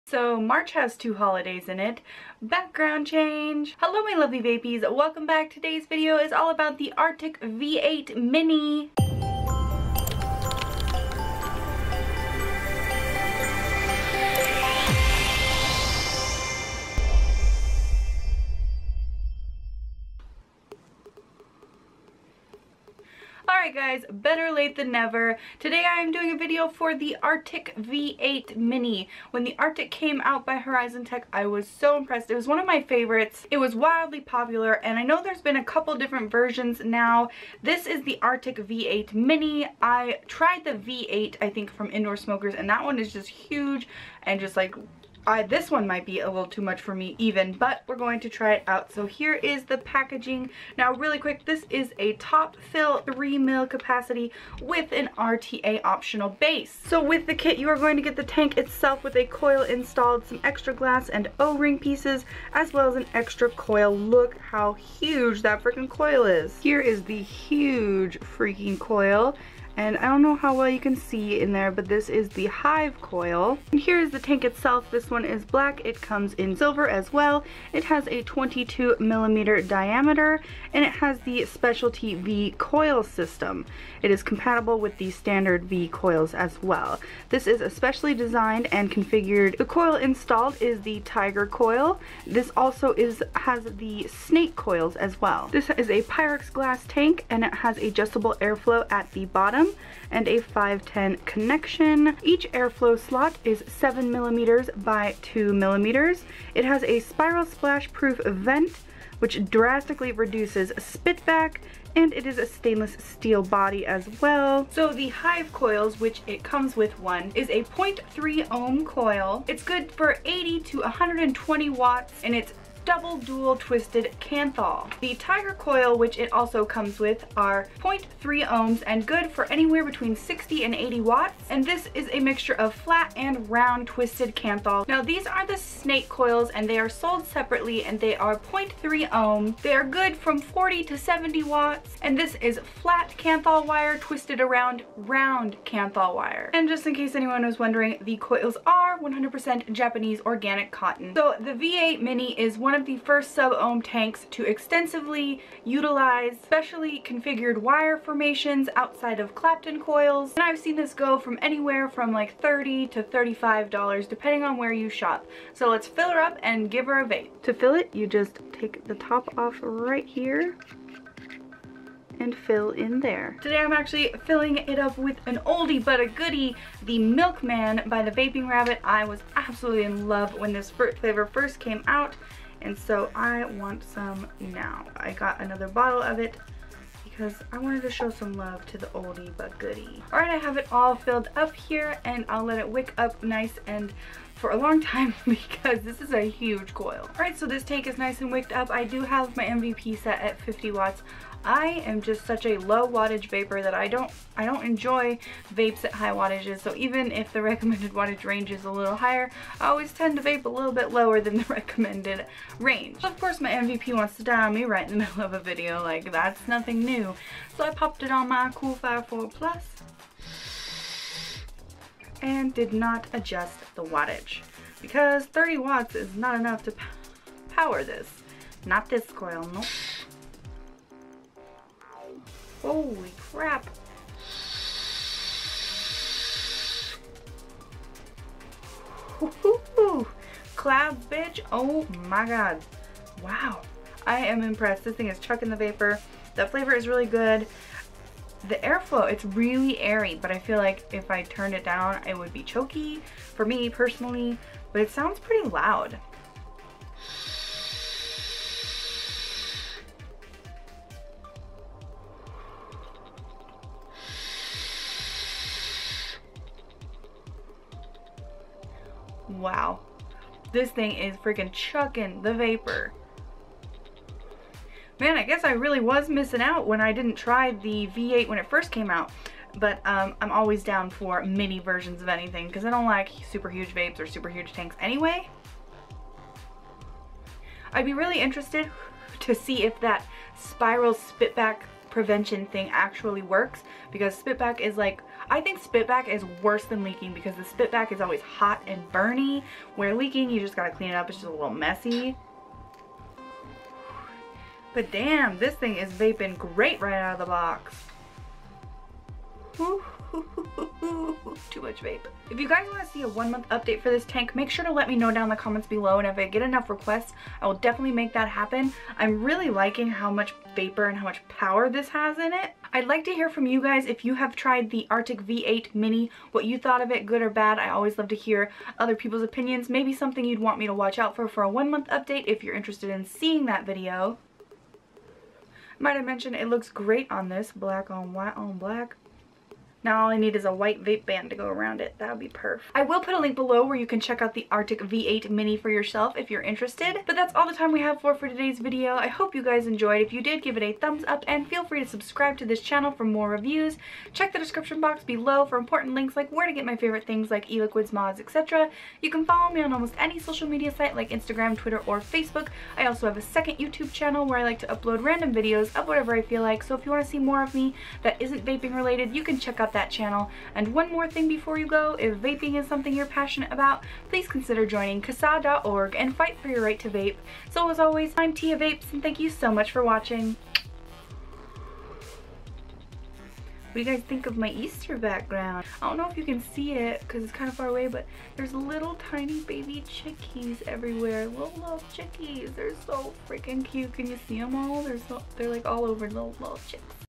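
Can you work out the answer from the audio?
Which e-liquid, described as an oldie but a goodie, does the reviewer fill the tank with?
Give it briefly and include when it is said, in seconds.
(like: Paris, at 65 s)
Milkman, at 176 s.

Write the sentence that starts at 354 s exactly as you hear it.
Check the description box below for important links like where to get my favorite things like e-liquids, mods, etc.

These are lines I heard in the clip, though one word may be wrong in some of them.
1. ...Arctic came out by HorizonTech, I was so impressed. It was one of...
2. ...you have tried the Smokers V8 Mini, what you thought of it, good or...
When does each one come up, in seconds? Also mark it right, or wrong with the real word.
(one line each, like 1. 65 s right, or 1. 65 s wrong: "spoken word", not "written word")
1. 29 s right
2. 324 s wrong: "Arctic", not "Smokers".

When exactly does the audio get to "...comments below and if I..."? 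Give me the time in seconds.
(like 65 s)
315 s.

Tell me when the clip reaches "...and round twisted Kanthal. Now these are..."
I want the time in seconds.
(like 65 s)
133 s.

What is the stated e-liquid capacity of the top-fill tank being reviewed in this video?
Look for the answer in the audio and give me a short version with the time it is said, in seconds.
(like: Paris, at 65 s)
3 ml, at 52 s.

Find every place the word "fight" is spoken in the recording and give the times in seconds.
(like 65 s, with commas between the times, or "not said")
376 s.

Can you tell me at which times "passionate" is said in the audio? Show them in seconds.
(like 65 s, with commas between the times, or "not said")
373 s.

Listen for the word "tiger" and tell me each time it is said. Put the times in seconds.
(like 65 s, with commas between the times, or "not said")
91 s, 125 s.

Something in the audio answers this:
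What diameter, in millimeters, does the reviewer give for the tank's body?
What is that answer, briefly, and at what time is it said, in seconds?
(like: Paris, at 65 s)
22 millimeters, at 78 s.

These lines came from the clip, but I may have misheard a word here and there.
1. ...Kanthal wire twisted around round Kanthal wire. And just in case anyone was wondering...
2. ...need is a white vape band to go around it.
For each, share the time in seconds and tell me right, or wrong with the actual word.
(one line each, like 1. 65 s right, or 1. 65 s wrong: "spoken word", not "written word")
1. 143 s right
2. 340 s right.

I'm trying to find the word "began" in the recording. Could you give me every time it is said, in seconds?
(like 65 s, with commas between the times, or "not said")
not said.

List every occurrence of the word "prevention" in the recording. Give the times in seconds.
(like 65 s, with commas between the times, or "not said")
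291 s.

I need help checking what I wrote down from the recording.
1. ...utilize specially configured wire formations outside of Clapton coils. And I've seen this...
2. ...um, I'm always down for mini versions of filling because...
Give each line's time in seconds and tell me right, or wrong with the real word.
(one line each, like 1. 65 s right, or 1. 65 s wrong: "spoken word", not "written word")
1. 155 s right
2. 279 s wrong: "anything", not "filling".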